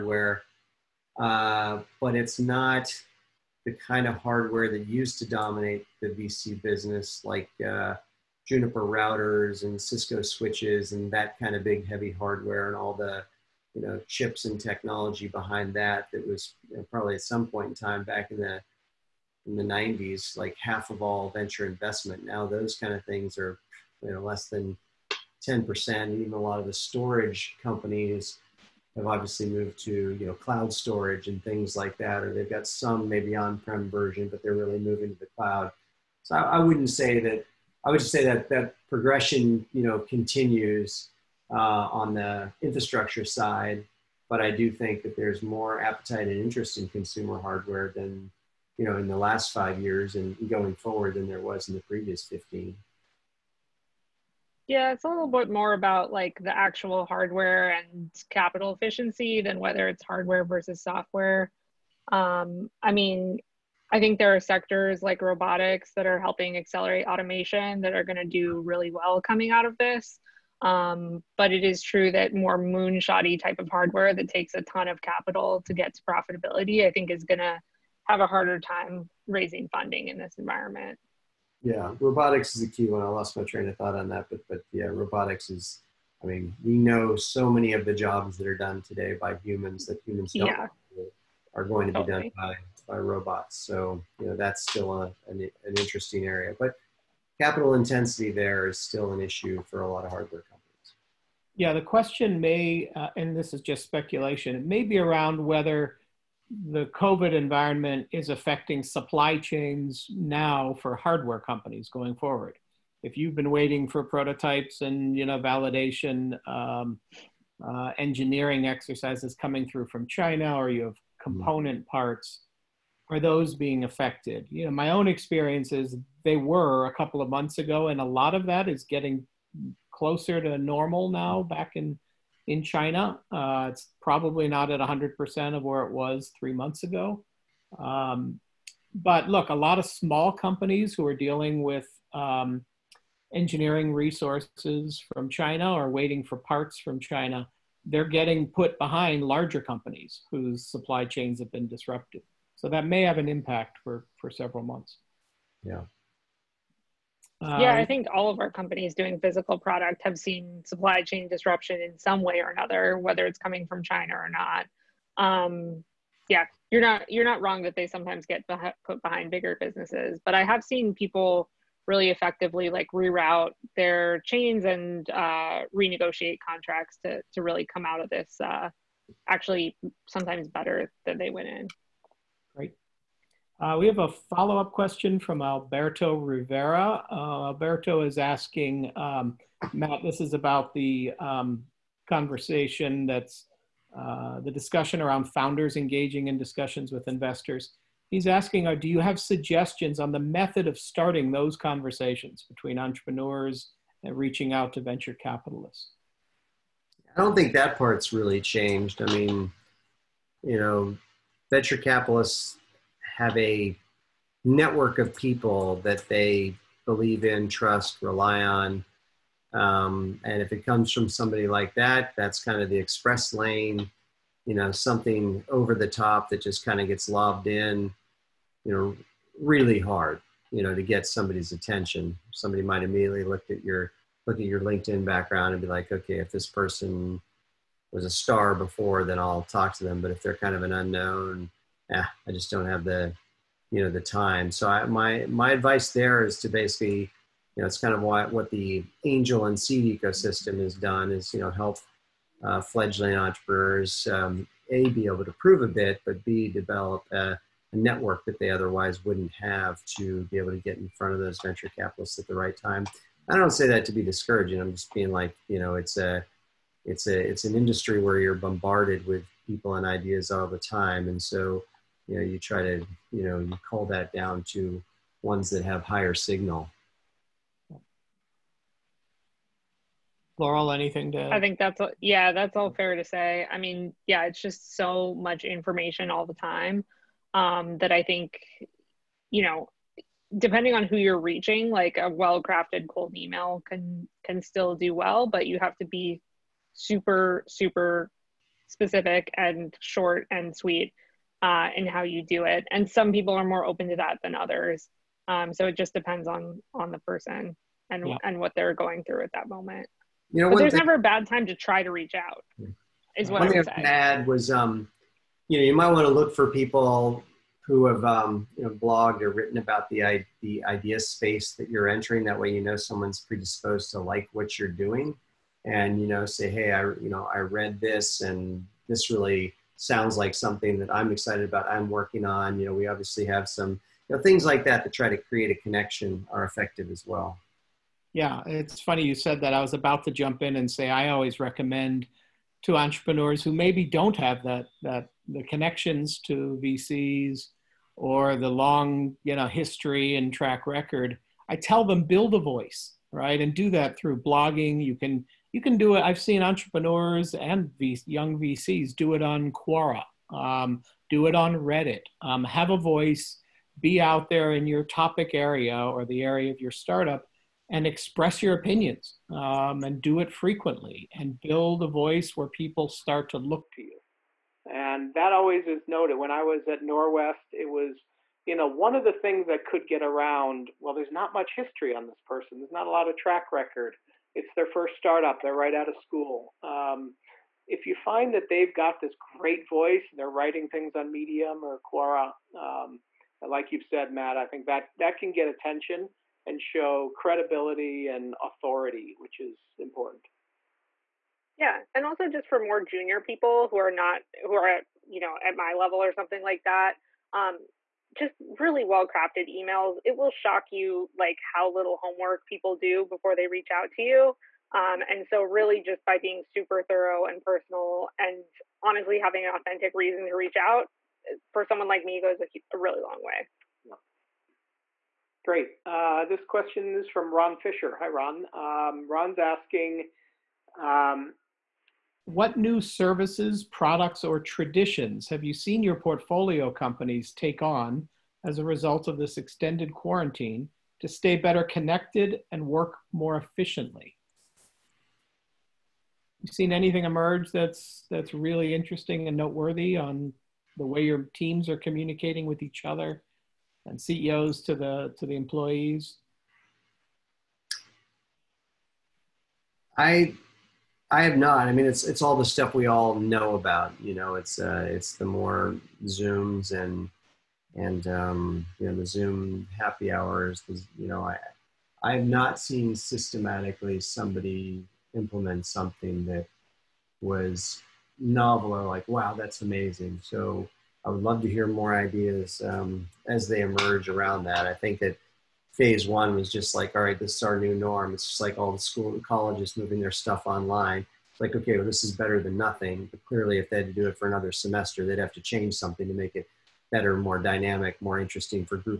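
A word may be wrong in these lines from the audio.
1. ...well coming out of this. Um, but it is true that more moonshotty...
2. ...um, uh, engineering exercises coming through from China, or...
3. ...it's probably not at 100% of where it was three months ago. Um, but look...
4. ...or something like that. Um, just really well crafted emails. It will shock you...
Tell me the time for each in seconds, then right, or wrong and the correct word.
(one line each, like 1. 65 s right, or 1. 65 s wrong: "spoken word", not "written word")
1. 68 s right
2. 116 s right
3. 133 s right
4. 406 s right.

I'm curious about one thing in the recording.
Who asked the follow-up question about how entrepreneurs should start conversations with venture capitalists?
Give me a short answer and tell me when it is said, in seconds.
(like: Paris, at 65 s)
Alberto Rivera, at 185 s.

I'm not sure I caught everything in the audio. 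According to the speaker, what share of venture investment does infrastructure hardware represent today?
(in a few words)
less than 10%.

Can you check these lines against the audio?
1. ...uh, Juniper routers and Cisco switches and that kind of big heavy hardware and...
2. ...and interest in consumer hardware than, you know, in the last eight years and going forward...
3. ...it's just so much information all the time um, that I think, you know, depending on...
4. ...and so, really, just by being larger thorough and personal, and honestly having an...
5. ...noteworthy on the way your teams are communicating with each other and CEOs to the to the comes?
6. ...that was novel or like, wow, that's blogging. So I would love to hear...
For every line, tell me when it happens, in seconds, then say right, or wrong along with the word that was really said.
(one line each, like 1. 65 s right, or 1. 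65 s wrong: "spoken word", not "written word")
1. 7 s right
2. 46 s wrong: "five", not "eight"
3. 284 s right
4. 415 s wrong: "super", not "larger"
5. 449 s wrong: "employees", not "comes"
6. 476 s wrong: "amazing", not "blogging".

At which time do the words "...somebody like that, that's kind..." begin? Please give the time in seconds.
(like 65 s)
221 s.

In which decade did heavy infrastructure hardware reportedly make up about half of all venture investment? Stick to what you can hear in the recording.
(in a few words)
the 90s.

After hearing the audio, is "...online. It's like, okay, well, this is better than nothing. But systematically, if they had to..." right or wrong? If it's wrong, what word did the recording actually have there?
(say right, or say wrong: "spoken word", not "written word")
wrong: "clearly", not "systematically".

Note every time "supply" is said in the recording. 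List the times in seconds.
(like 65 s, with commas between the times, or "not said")
108 s, 150 s, 160 s.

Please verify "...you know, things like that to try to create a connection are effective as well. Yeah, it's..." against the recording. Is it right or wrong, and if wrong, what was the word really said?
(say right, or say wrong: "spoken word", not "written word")
right.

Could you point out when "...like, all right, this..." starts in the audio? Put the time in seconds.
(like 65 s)
486 s.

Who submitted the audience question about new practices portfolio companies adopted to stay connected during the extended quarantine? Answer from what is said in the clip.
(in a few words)
Ron Fisher.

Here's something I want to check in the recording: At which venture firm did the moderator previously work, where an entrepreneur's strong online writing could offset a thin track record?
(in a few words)
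Norwest.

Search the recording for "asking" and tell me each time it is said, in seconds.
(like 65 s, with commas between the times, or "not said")
188 s, 198 s, 429 s.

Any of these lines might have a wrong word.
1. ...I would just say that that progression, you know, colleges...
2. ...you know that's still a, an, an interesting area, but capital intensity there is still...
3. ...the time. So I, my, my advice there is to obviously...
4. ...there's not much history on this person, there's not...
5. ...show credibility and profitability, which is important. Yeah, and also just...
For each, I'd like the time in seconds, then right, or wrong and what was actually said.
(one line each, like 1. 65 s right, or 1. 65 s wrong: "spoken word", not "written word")
1. 37 s wrong: "continues", not "colleges"
2. 94 s right
3. 243 s wrong: "basically", not "obviously"
4. 380 s right
5. 396 s wrong: "authority", not "profitability".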